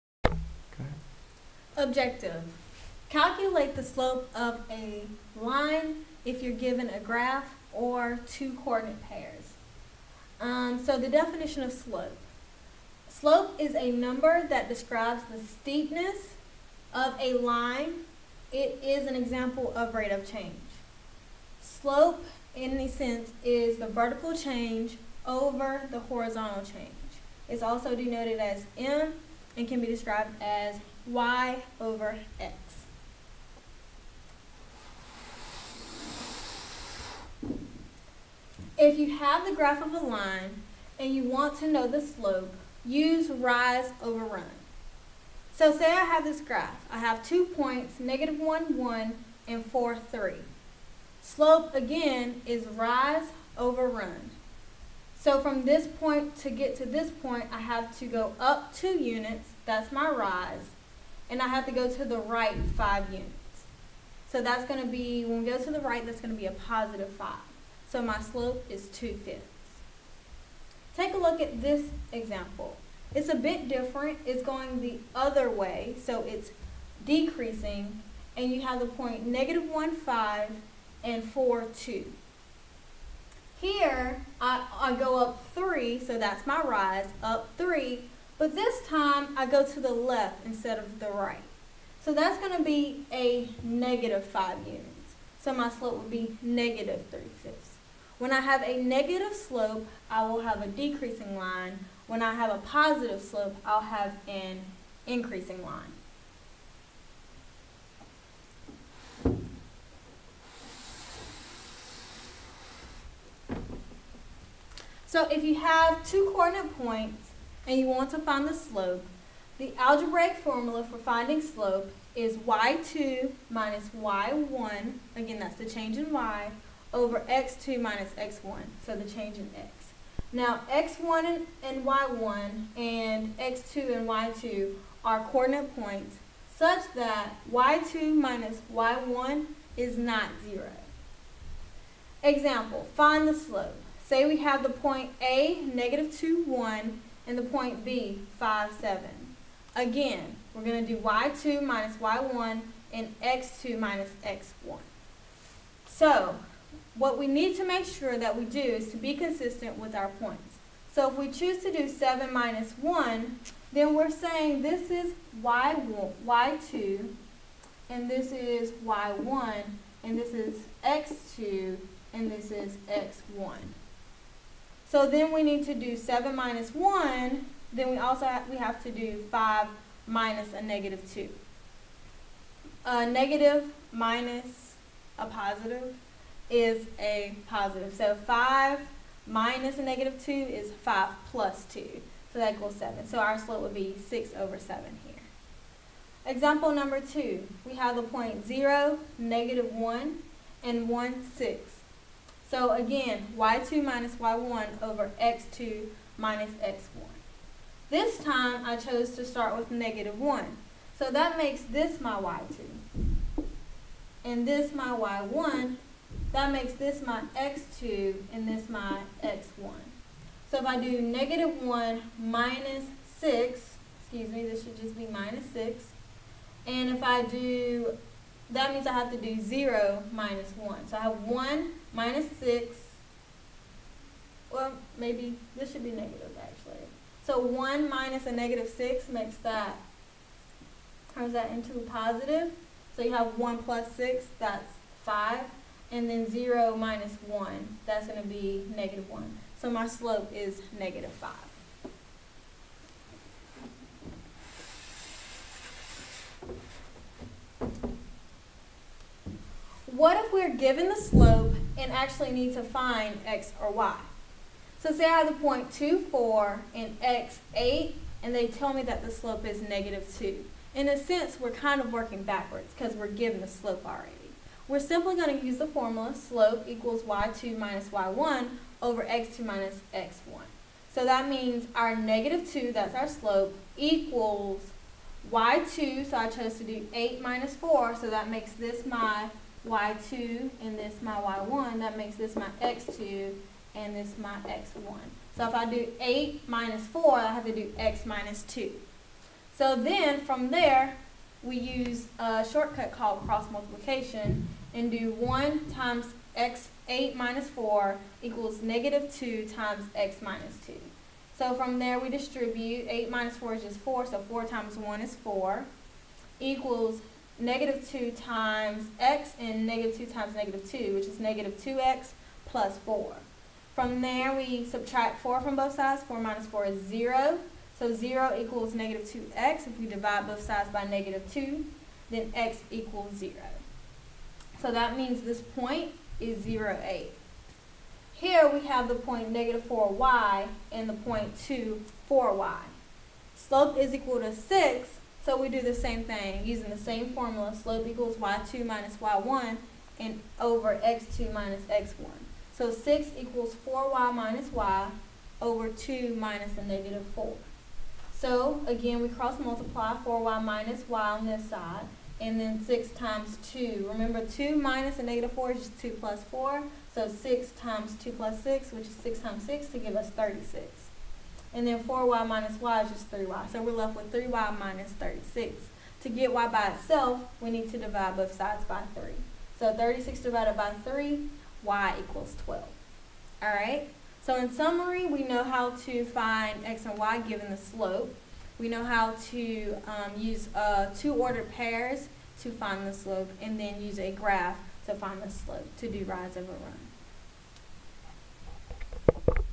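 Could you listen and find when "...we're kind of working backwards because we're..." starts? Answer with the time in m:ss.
4:31.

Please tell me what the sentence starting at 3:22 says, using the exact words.
So again, y2 minus y1 over x2 minus x1.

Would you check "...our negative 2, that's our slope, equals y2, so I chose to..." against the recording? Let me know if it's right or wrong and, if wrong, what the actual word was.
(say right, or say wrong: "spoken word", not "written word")
right.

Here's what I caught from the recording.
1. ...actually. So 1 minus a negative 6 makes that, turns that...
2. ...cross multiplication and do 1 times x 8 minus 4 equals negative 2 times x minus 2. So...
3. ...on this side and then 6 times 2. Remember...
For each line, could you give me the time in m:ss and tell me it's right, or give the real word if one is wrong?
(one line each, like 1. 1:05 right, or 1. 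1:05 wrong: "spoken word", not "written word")
1. 3:56 right
2. 5:03 right
3. 6:01 right.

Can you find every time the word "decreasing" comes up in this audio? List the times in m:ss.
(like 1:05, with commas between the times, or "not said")
1:17, 1:40.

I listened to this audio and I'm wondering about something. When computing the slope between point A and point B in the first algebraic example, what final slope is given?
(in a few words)
6/7.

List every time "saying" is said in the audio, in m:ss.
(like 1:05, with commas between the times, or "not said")
2:44.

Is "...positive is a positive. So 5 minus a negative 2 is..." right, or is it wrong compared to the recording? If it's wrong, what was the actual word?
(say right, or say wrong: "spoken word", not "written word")
right.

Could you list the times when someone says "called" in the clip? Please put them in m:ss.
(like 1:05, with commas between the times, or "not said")
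5:02.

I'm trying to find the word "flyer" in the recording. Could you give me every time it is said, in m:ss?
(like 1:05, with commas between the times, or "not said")
not said.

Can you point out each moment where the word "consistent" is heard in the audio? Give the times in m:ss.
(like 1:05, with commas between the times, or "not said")
2:39.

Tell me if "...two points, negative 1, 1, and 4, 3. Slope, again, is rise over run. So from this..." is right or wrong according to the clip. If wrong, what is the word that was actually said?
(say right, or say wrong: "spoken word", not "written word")
right.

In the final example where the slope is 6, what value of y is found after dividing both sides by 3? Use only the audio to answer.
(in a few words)
12.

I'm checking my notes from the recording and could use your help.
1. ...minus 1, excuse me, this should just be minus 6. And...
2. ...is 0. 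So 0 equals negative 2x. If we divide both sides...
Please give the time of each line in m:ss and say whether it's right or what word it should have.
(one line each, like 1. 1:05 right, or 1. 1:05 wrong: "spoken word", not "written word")
1. 3:42 wrong: "6", not "1"
2. 5:26 right.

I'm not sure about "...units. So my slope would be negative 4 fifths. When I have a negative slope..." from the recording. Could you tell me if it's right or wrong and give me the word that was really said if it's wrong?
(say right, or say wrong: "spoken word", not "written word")
wrong: "3", not "4".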